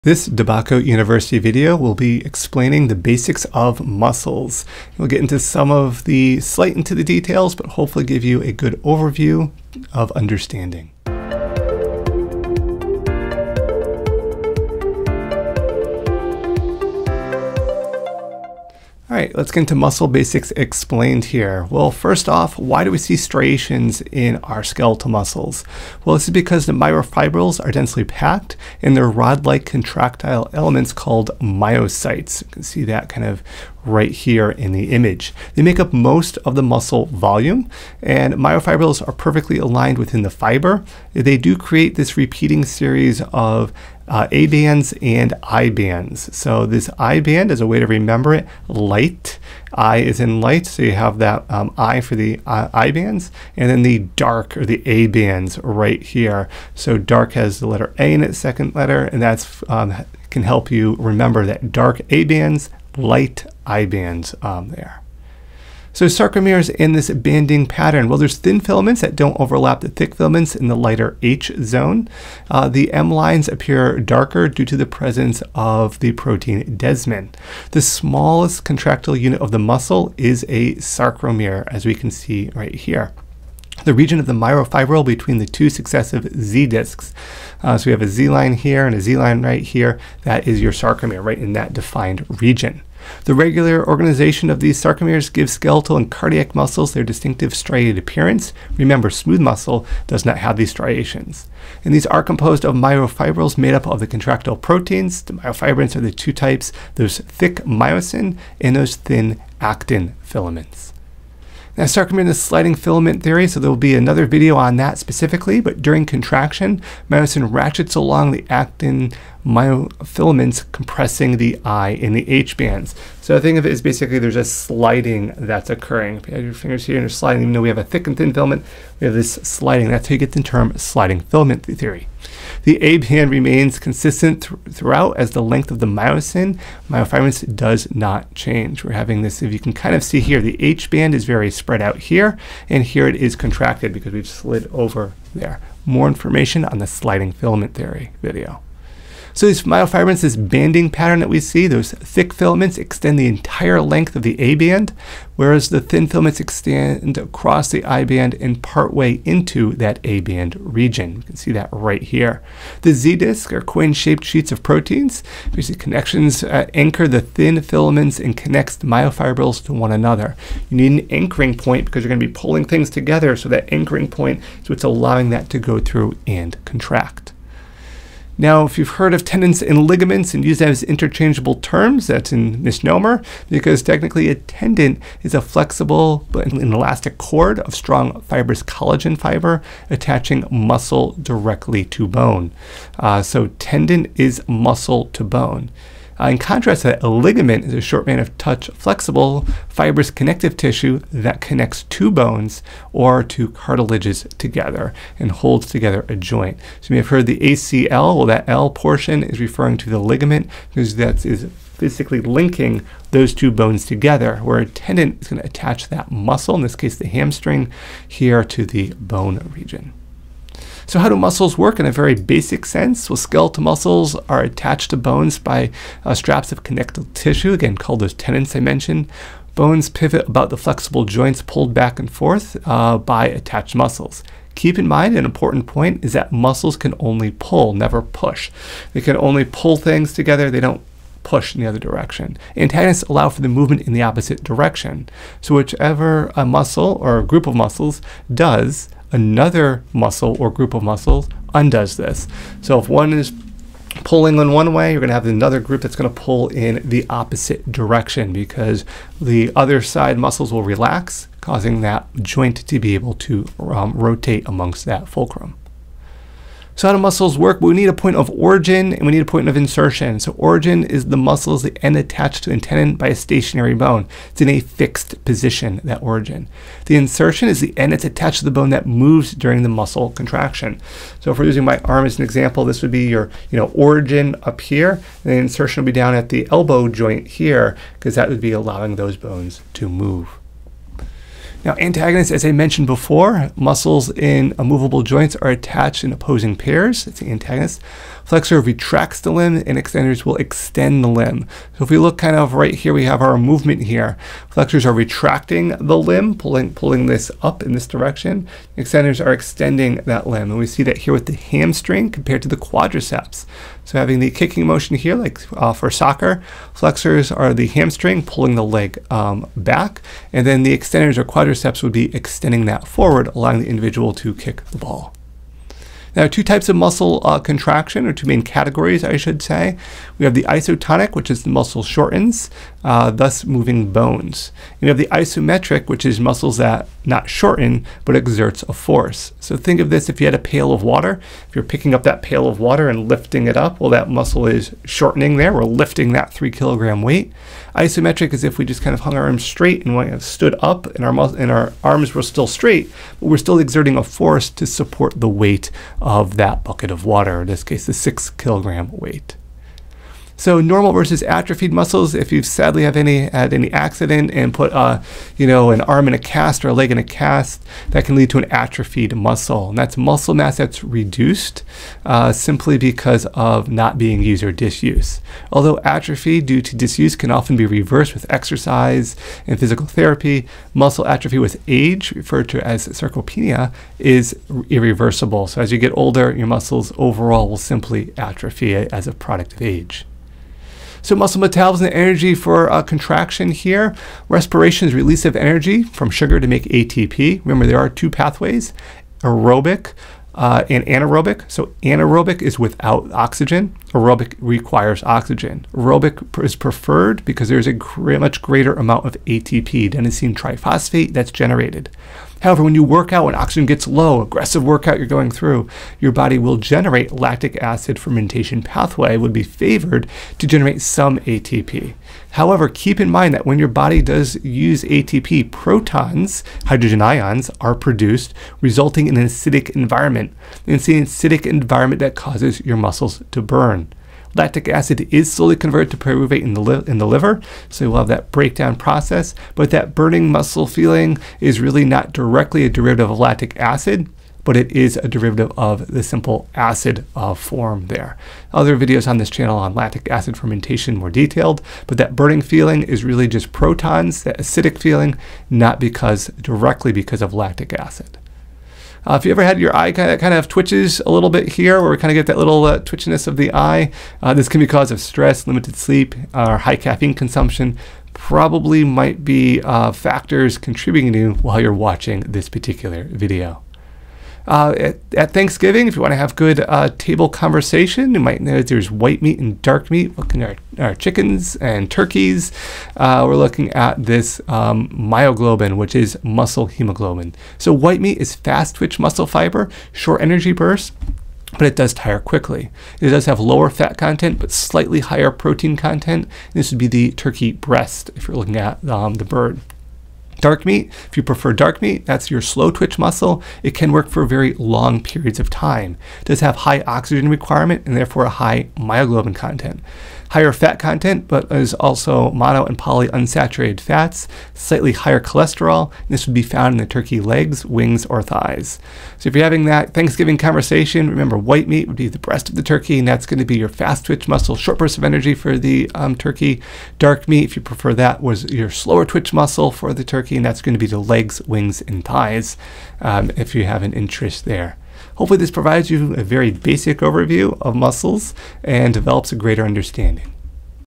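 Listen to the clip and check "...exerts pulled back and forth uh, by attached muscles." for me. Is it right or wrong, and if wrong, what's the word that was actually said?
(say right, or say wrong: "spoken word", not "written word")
wrong: "joints", not "exerts".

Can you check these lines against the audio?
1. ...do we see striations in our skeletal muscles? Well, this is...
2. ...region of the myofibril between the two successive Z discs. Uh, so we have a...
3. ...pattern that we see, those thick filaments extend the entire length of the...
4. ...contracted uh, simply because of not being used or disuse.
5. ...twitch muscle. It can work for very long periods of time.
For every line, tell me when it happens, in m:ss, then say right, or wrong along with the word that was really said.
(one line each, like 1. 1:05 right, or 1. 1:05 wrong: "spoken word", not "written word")
1. 0:22 right
2. 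1:23 right
3. 2:30 right
4. 6:10 wrong: "reduced", not "contracted"
5. 8:22 right.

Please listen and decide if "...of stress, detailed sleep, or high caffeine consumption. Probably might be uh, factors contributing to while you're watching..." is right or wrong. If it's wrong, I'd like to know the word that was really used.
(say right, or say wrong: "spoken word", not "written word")
wrong: "limited", not "detailed".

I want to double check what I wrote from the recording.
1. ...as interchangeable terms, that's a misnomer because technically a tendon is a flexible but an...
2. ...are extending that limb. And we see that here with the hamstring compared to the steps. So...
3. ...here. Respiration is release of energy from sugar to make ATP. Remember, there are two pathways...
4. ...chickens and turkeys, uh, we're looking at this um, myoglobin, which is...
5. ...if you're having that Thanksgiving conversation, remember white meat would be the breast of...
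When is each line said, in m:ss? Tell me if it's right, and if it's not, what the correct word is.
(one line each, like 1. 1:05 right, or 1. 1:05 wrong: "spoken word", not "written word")
1. 3:00 right
2. 5:09 wrong: "quadriceps", not "steps"
3. 6:33 right
4. 8:00 right
5. 8:39 right.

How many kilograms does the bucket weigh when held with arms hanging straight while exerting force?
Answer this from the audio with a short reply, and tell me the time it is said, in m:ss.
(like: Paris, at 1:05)
6 kilograms, at 5:57.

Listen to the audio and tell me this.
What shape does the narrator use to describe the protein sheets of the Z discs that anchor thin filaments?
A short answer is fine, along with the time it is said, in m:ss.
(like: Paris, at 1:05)
coin-shaped, at 2:43.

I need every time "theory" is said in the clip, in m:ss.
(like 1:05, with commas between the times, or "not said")
1:53, 2:11, 2:27.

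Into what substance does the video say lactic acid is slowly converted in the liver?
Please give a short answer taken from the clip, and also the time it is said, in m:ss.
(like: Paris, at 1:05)
pyruvate, at 7:15.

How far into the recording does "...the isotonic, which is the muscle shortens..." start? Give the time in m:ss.
5:30.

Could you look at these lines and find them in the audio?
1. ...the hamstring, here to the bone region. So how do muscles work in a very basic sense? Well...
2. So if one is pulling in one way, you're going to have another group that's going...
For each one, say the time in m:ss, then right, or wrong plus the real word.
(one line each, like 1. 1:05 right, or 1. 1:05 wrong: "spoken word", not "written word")
1. 3:36 right
2. 4:12 right.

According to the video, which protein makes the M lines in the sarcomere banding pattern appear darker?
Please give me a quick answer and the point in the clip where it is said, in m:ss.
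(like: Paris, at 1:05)
desmin, at 1:16.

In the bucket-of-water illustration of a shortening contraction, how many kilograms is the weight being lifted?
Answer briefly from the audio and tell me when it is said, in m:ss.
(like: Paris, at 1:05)
3 kilograms, at 5:46.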